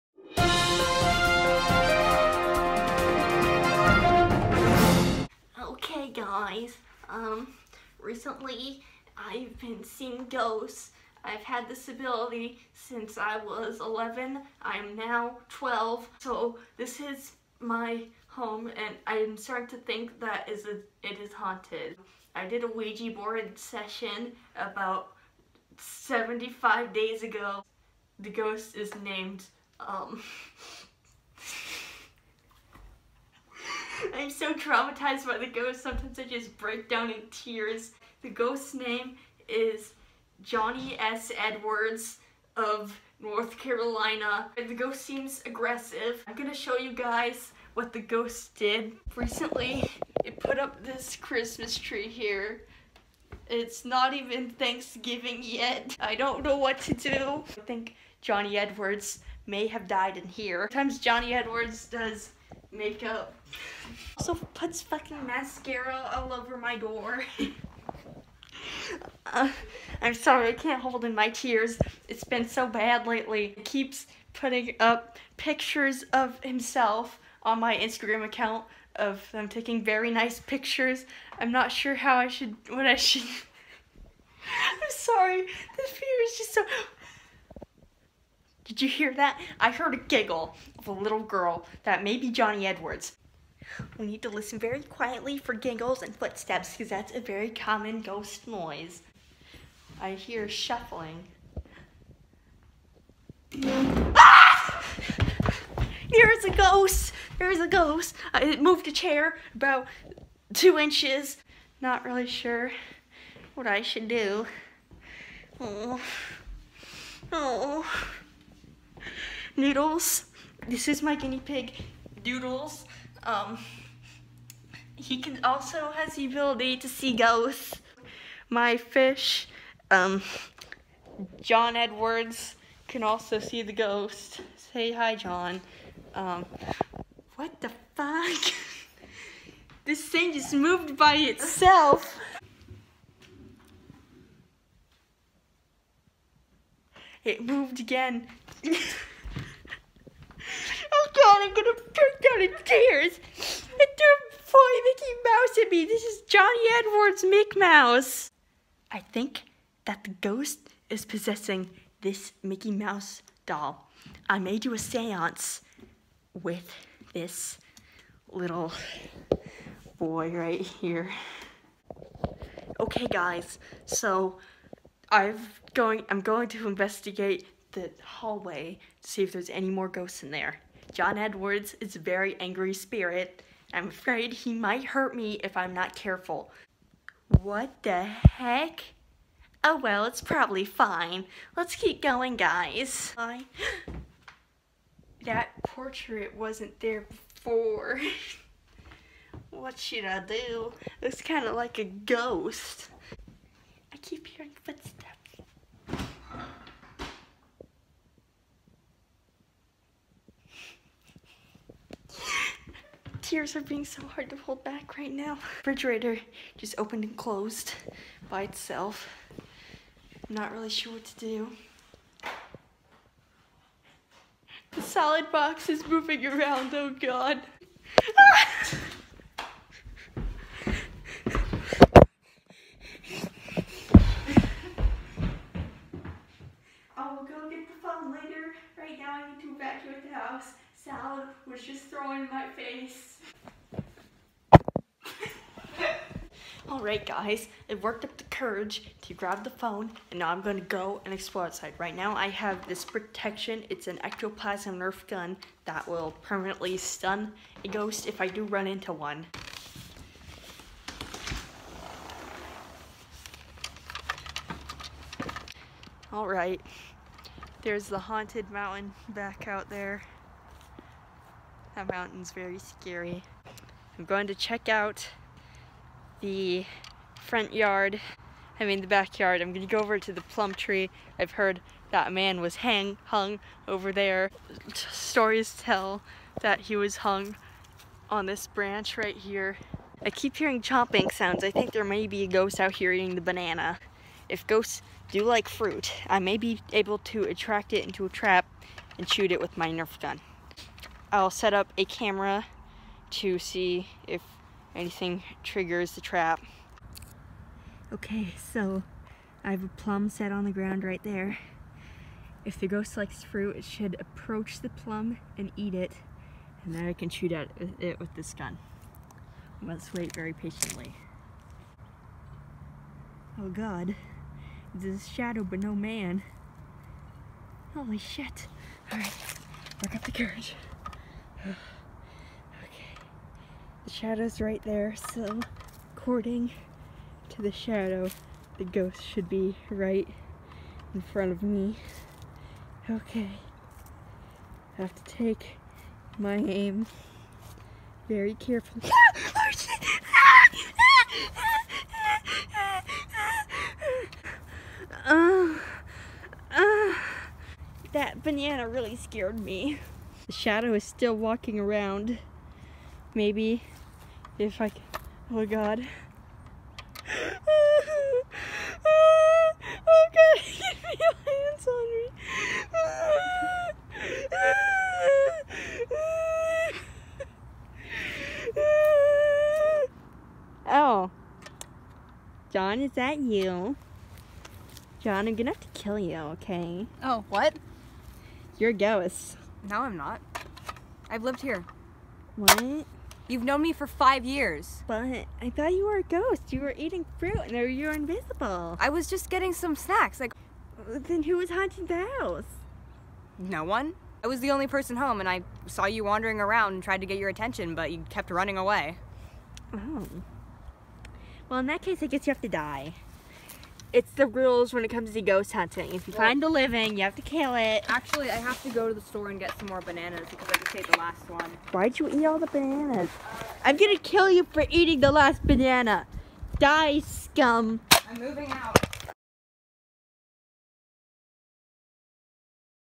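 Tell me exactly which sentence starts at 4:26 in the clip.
Alright, there's the haunted mountain back out there.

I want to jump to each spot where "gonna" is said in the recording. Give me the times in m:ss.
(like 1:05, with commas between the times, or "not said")
0:46, 2:31, 4:39, 6:25, 7:03.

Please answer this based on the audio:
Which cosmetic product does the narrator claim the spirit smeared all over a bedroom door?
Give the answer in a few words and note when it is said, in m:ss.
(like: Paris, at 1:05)
Mascara, at 1:05.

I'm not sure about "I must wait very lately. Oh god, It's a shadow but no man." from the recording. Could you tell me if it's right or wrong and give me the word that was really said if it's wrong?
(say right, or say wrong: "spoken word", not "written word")
wrong: "patiently", not "lately".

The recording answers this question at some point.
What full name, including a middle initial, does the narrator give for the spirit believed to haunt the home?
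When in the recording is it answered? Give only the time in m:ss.
0:40.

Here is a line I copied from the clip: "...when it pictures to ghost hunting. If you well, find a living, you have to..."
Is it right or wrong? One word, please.
wrong.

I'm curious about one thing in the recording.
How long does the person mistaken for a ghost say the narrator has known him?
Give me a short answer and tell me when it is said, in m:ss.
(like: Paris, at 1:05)
5 years, at 6:33.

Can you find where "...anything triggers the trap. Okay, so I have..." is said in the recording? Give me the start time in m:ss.
5:04.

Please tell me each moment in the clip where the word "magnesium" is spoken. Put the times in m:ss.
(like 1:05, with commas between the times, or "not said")
not said.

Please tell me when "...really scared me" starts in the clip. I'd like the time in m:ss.
5:58.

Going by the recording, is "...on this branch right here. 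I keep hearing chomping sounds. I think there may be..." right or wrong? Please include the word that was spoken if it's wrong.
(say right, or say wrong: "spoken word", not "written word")
right.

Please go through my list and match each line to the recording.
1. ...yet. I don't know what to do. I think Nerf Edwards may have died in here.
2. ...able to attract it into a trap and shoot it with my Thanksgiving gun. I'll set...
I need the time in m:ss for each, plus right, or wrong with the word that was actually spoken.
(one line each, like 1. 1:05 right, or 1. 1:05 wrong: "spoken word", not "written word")
1. 0:55 wrong: "Johnny", not "Nerf"
2. 4:56 wrong: "Nerf", not "Thanksgiving".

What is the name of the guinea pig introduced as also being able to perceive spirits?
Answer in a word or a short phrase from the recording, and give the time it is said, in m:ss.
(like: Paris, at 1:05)
Doodles, at 2:02.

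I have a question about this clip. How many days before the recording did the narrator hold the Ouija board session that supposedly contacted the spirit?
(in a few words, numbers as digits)
75.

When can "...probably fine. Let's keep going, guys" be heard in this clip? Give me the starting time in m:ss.
3:10.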